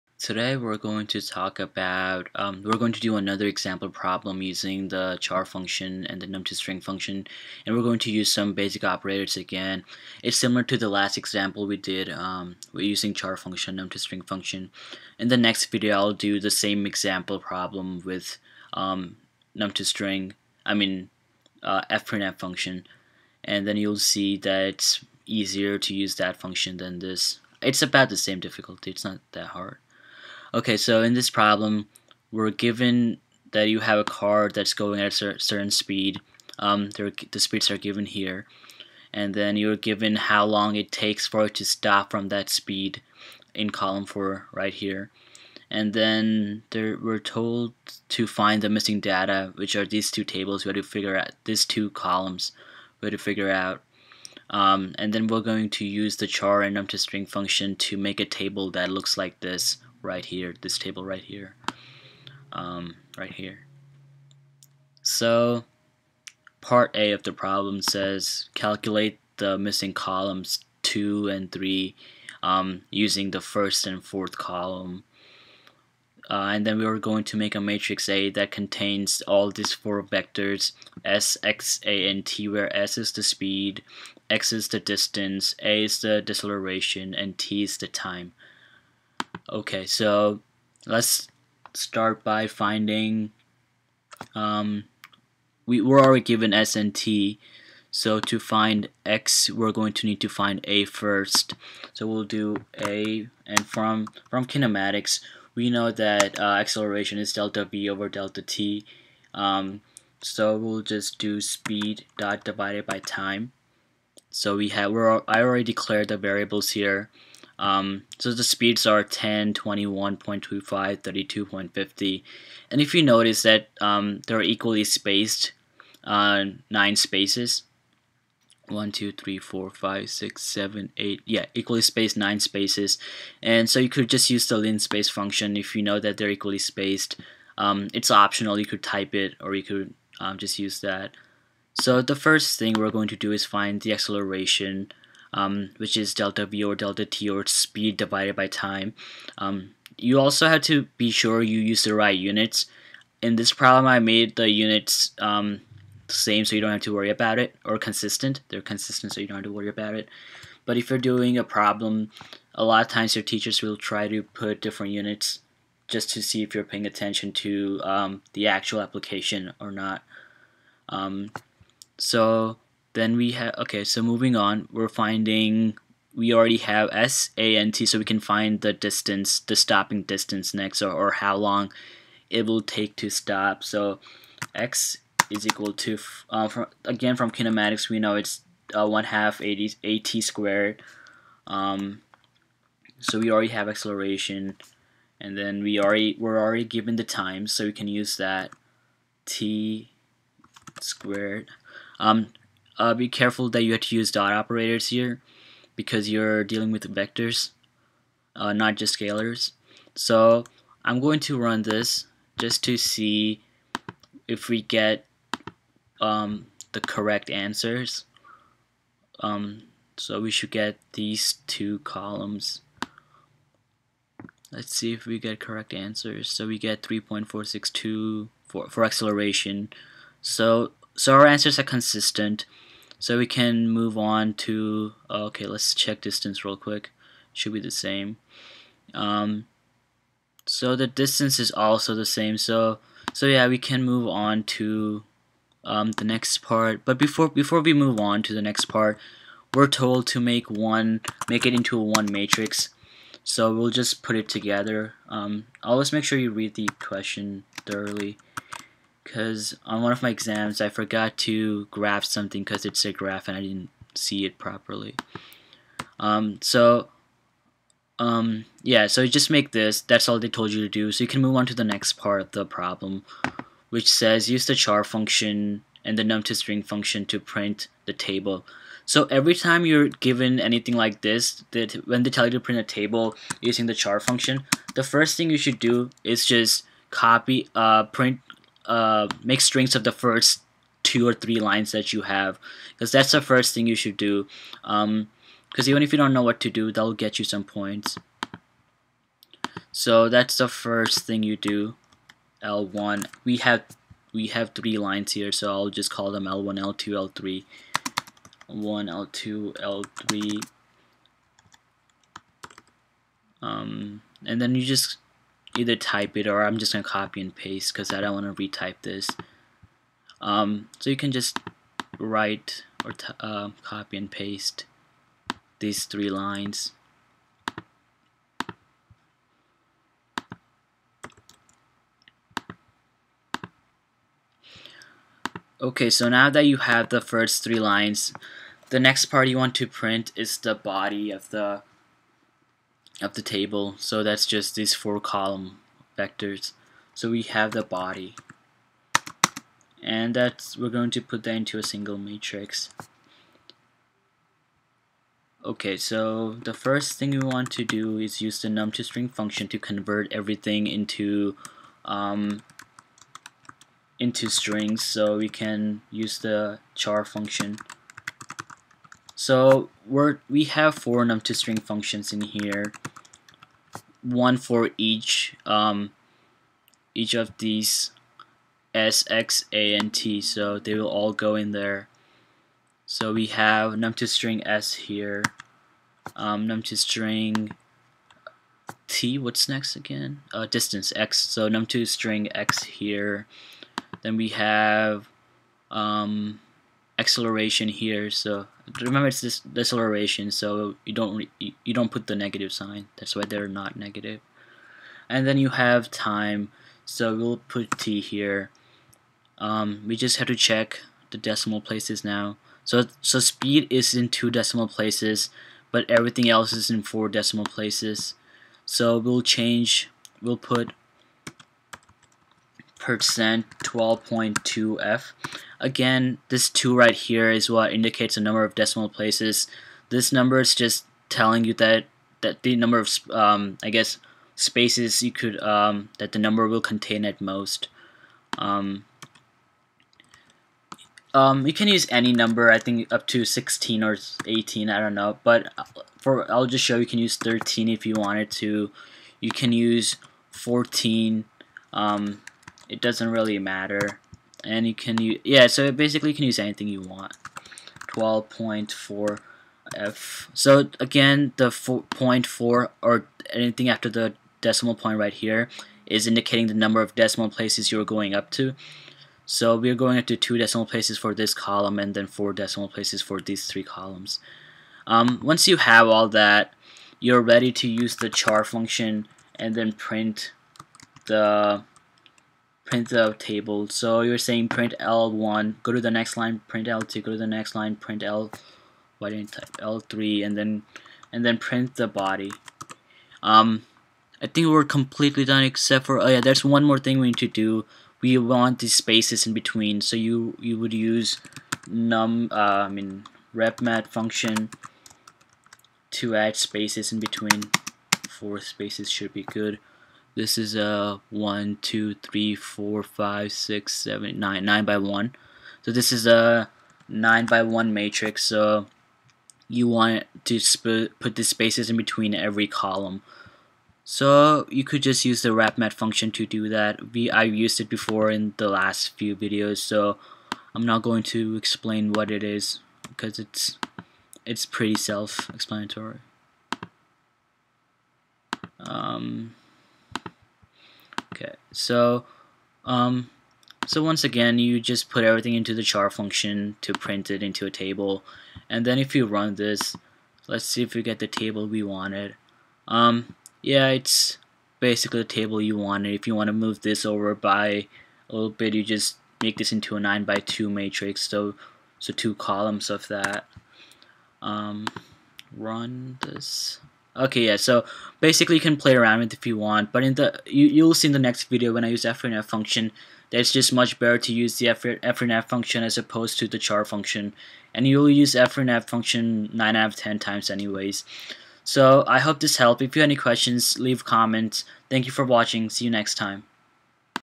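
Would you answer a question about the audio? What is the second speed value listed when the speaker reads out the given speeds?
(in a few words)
21.25.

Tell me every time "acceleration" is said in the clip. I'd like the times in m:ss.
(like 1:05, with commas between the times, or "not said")
1:46, 2:23, 3:13, 3:48, 6:36.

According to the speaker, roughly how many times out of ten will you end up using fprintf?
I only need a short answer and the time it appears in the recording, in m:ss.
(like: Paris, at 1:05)
9, at 9:39.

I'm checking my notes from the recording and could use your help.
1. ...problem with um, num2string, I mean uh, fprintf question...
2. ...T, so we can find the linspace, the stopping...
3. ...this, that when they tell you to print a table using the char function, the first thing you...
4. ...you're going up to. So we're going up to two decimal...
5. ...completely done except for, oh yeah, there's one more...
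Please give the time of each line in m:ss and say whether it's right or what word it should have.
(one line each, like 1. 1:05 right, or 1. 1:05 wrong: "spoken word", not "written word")
1. 0:17 wrong: "function", not "question"
2. 2:57 wrong: "distance", not "linspace"
3. 4:41 right
4. 7:47 right
5. 8:14 right.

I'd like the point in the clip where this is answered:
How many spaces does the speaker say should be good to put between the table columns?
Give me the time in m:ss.
8:28.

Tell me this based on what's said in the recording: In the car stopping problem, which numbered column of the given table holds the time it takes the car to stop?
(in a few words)
column 4.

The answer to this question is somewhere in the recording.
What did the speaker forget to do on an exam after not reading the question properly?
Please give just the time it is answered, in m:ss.
4:21.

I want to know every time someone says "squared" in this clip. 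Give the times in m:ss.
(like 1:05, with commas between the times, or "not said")
3:10, 3:20.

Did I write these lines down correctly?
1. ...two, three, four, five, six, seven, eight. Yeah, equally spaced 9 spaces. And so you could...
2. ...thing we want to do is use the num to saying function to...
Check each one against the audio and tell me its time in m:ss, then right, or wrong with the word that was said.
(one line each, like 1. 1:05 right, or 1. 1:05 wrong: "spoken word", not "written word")
1. 2:08 right
2. 5:56 wrong: "string", not "saying".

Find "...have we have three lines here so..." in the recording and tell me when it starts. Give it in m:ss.
5:03.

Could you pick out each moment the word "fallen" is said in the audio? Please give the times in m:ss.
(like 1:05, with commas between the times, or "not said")
not said.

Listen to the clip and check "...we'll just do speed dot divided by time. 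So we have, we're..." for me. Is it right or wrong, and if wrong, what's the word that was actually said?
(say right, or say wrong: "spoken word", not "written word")
right.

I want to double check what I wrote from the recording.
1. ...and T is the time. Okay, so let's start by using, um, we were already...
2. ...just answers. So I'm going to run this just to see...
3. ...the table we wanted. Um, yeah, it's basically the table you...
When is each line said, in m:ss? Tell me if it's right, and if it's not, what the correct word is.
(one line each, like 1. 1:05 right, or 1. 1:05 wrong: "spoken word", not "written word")
1. 1:27 wrong: "finding", not "using"
2. 3:28 wrong: "scalars", not "answers"
3. 9:10 right.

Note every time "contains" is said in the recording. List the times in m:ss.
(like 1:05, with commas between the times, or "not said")
1:18, 7:16.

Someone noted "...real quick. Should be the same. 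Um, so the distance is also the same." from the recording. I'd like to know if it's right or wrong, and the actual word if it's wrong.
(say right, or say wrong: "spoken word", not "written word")
right.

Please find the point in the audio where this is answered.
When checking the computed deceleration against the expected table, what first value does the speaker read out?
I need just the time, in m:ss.
3:46.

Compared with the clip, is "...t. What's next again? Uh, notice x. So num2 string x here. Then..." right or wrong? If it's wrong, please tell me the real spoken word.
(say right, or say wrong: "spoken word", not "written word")
wrong: "distance", not "notice".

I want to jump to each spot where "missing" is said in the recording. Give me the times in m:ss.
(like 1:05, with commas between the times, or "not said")
0:48, 1:09.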